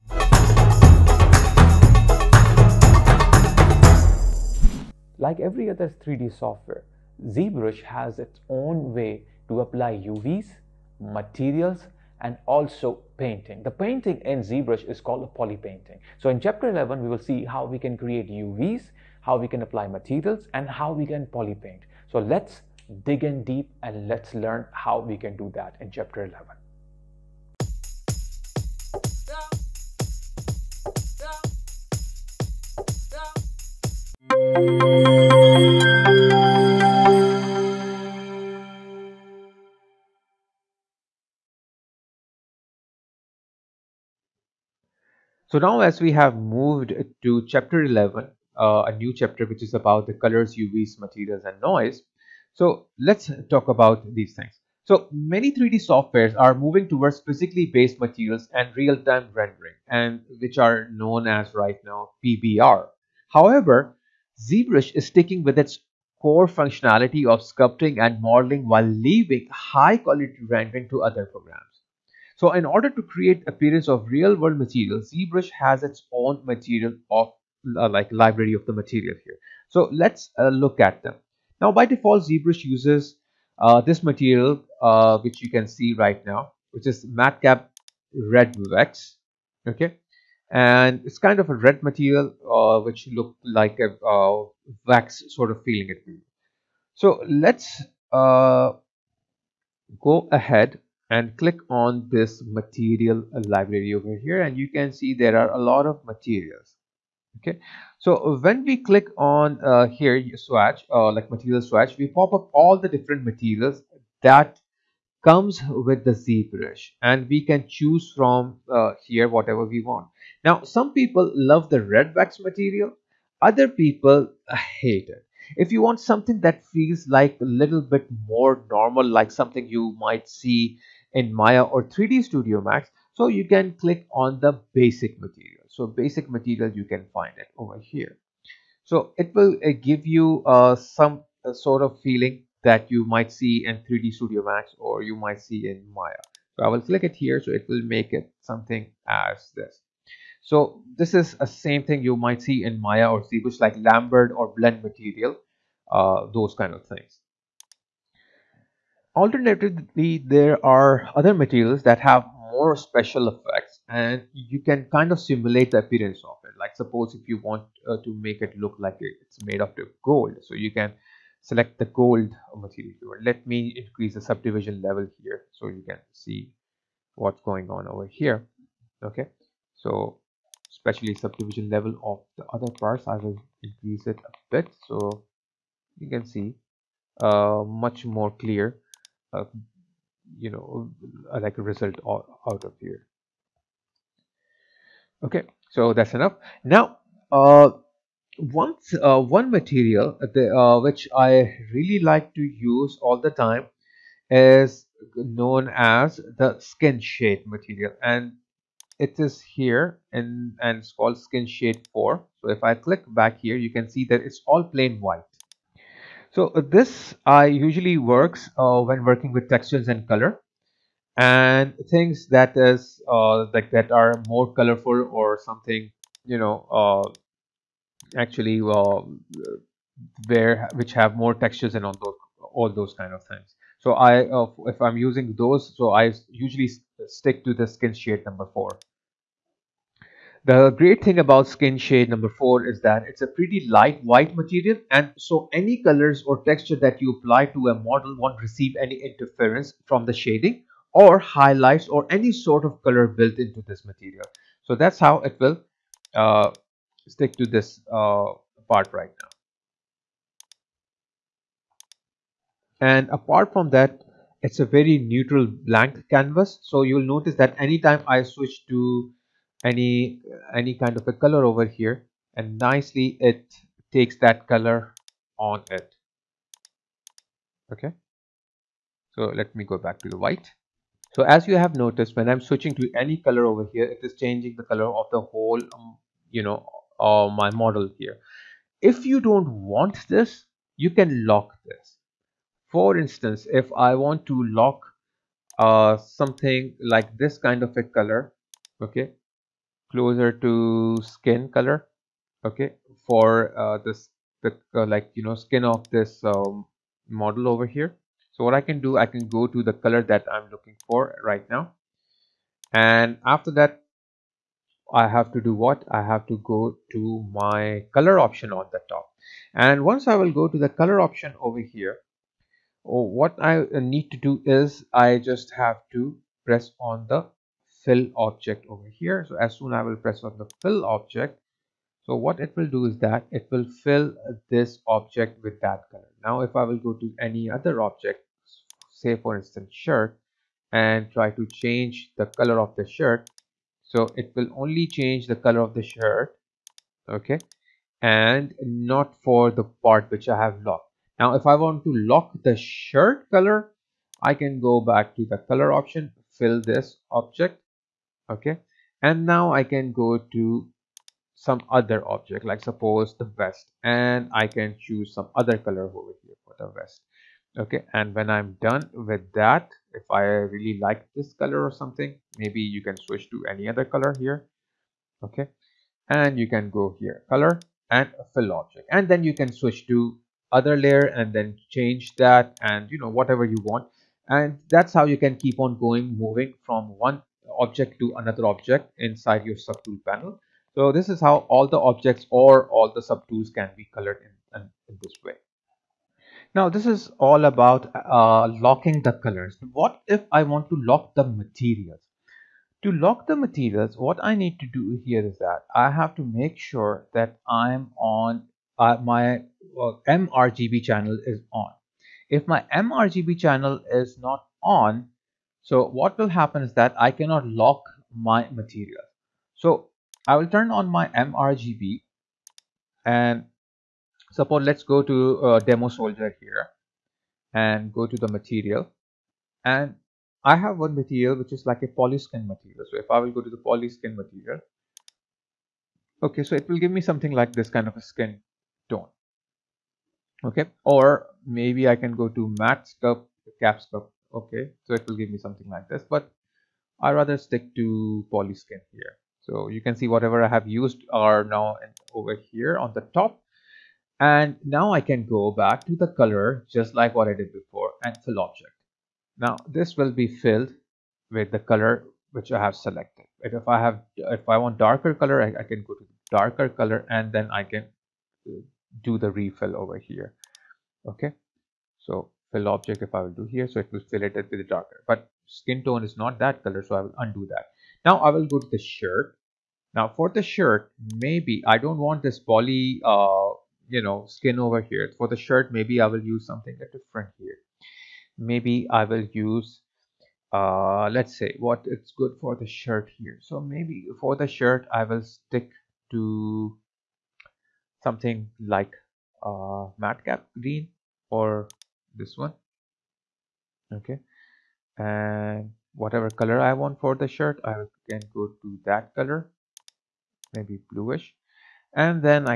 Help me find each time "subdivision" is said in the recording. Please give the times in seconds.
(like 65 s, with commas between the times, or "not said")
174 s, 181 s.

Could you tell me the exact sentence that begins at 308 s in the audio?
So what I can do, I can go to the color that I'm looking for right now.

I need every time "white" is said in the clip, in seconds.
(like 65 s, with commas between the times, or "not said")
214 s, 244 s, 280 s.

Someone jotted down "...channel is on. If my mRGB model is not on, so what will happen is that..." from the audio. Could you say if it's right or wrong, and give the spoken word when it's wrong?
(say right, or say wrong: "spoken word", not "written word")
wrong: "channel", not "model".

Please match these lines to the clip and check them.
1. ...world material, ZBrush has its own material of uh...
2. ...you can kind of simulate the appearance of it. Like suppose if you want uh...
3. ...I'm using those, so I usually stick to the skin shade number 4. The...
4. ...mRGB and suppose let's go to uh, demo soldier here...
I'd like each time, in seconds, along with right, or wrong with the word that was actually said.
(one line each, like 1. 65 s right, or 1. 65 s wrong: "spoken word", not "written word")
1. 74 s right
2. 164 s right
3. 234 s right
4. 421 s right.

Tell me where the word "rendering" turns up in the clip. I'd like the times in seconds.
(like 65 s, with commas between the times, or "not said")
59 s, 70 s.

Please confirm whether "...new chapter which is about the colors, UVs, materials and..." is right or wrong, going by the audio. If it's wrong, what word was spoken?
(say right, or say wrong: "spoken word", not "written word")
right.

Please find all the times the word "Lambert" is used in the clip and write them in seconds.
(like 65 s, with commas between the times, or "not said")
153 s.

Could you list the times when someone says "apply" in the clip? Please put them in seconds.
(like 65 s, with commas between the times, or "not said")
9 s, 19 s, 247 s.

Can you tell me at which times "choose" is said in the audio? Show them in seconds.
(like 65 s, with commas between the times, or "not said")
117 s, 364 s.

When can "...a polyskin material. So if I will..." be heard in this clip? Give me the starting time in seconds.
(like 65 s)
431 s.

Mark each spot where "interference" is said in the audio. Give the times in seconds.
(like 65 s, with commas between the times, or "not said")
249 s.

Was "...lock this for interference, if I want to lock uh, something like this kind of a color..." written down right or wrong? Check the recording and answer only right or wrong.
wrong.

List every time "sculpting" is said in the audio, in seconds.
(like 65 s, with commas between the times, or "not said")
67 s.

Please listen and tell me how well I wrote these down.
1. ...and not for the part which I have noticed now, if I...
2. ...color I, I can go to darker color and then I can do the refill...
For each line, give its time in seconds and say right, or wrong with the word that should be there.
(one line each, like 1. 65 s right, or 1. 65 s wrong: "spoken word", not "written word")
1. 348 s wrong: "locked", not "noticed"
2. 465 s right.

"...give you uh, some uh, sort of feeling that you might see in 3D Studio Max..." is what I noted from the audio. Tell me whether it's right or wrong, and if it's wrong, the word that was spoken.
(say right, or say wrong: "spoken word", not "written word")
right.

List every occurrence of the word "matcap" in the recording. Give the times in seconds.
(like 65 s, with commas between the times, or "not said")
87 s, 500 s.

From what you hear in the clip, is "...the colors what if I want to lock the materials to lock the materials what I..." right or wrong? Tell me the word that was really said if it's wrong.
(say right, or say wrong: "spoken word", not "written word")
right.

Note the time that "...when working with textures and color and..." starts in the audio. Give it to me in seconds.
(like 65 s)
218 s.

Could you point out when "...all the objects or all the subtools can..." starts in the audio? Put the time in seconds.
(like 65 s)
391 s.